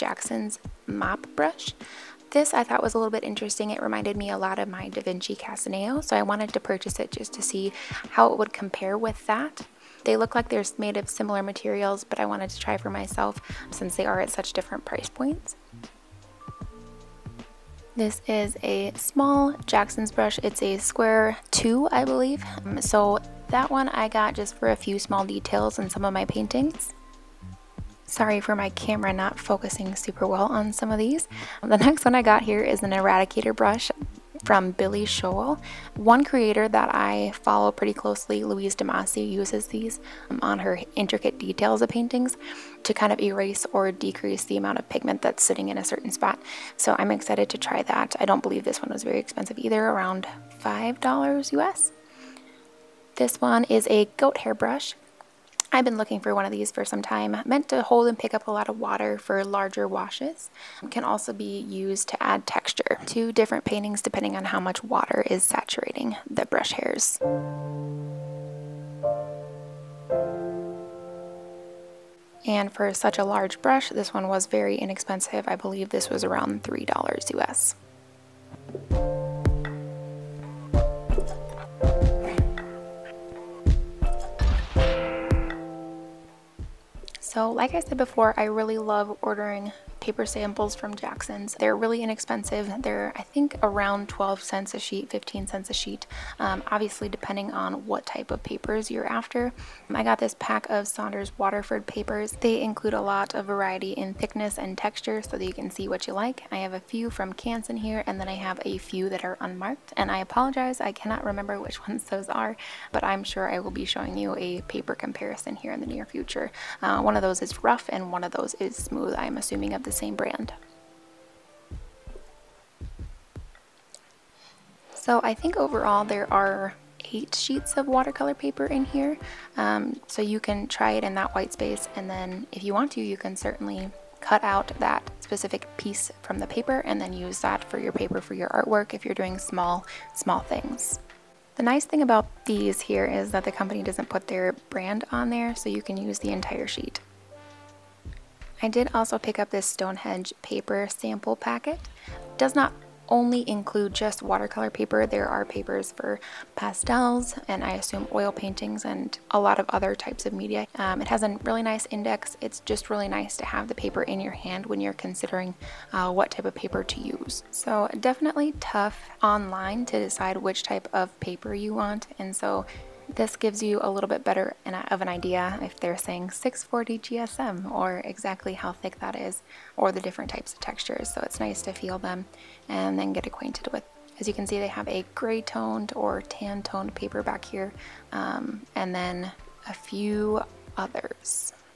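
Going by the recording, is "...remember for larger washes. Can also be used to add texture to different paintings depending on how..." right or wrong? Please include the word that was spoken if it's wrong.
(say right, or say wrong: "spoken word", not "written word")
wrong: "water", not "remember".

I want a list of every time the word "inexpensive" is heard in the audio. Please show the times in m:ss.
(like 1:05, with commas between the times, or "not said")
1:14, 1:32.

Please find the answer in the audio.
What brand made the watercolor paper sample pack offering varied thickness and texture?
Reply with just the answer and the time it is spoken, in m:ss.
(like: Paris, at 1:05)
Saunders Waterford, at 1:40.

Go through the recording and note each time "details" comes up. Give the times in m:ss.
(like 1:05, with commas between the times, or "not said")
0:25, 0:41.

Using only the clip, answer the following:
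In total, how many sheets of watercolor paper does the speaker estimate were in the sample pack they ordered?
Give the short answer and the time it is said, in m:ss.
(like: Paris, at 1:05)
8, at 2:07.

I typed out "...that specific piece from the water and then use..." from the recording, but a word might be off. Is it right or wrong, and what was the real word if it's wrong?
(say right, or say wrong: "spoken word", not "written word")
wrong: "paper", not "water".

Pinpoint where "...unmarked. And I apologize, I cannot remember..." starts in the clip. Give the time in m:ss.
1:49.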